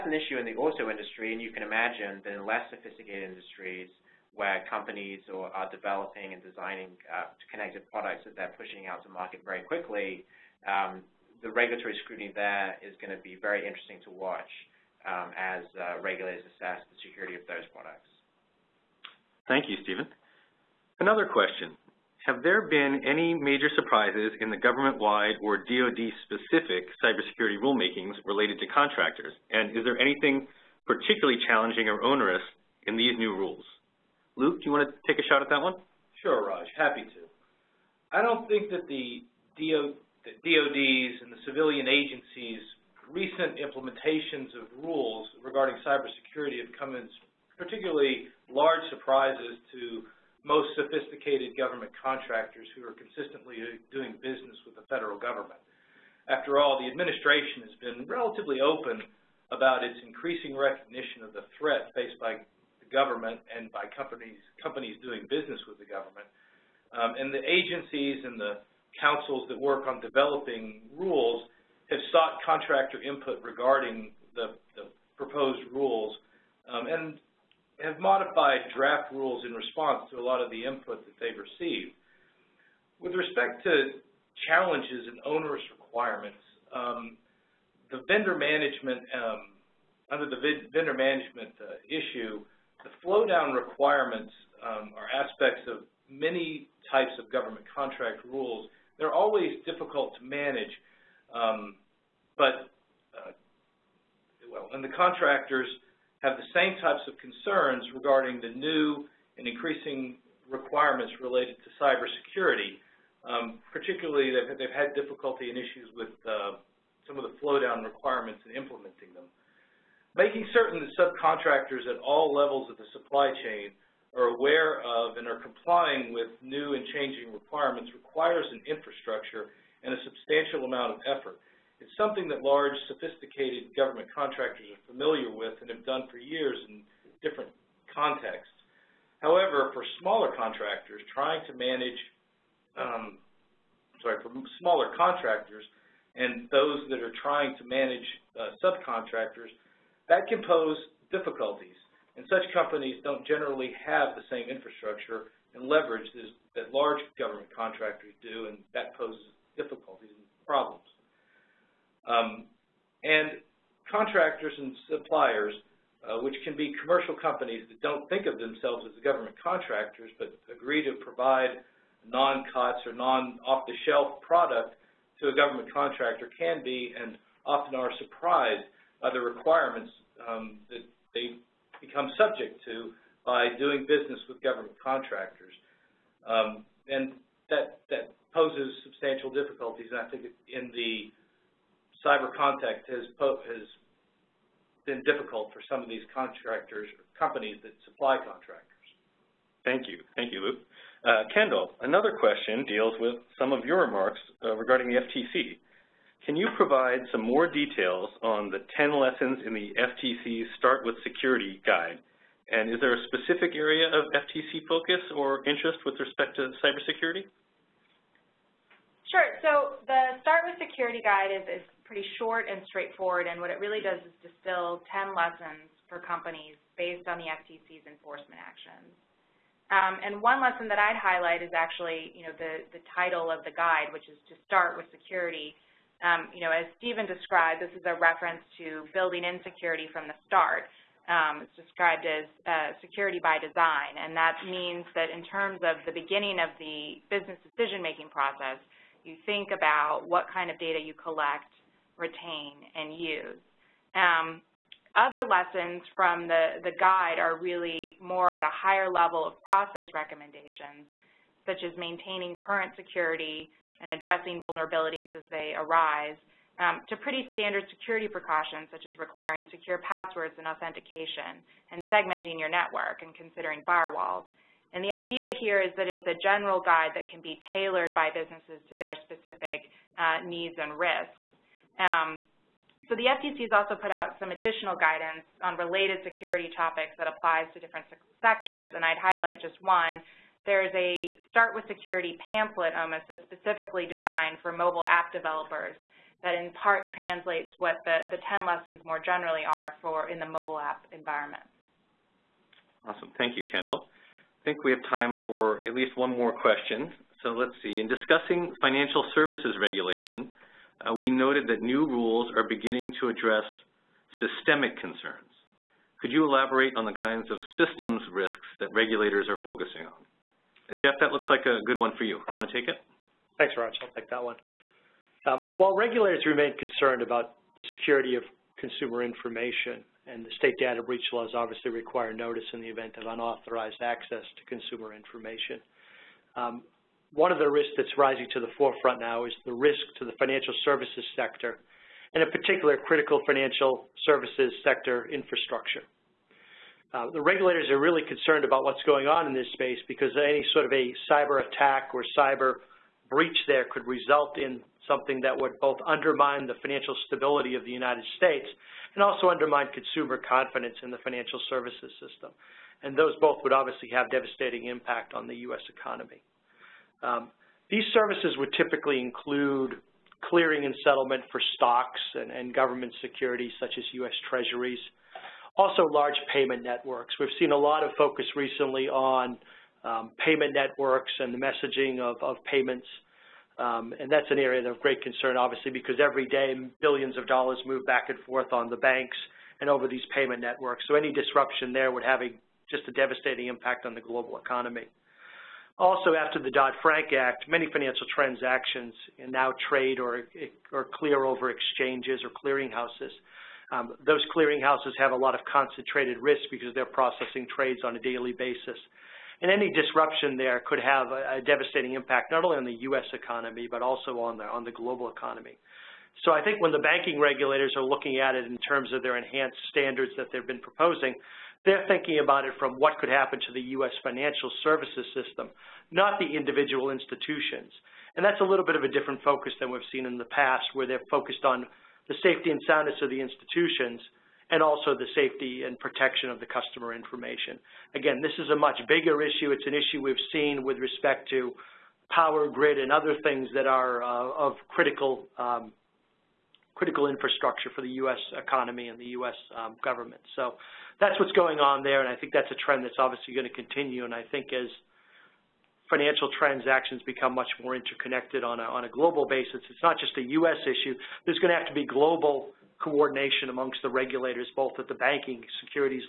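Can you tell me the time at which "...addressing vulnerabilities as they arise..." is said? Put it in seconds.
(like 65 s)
263 s.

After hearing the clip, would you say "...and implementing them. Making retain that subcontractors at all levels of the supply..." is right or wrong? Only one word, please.
wrong.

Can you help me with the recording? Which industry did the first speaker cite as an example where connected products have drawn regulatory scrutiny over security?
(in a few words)
auto industry.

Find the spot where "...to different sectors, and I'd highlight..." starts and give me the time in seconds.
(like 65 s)
287 s.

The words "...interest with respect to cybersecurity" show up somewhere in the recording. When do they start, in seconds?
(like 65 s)
215 s.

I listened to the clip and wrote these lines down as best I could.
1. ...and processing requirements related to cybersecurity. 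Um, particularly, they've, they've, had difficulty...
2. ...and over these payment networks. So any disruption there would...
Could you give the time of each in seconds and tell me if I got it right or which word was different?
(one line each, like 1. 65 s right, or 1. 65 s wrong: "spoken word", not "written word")
1. 109 s wrong: "increasing", not "processing"
2. 389 s right.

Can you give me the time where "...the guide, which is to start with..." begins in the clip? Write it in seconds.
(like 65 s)
233 s.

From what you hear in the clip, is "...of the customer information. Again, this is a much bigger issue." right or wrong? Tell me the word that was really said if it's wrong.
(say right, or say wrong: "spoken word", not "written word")
right.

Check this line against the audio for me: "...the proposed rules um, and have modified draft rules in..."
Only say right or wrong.
right.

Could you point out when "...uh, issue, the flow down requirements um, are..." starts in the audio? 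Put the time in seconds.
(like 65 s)
91 s.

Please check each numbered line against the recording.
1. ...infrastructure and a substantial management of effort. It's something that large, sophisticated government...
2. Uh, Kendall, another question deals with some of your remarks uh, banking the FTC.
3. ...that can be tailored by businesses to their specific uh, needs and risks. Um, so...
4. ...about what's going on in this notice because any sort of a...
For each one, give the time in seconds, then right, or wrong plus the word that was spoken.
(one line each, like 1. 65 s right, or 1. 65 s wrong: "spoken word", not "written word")
1. 128 s wrong: "amount", not "management"
2. 201 s wrong: "regarding", not "banking"
3. 276 s right
4. 348 s wrong: "space", not "notice".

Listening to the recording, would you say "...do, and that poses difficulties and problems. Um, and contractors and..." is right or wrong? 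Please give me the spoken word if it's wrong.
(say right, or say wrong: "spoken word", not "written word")
right.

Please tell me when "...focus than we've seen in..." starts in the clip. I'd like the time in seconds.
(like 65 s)
429 s.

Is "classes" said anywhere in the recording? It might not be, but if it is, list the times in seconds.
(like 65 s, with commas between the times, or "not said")
not said.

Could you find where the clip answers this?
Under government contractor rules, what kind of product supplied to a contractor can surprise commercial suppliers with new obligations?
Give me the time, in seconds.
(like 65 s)
172 s.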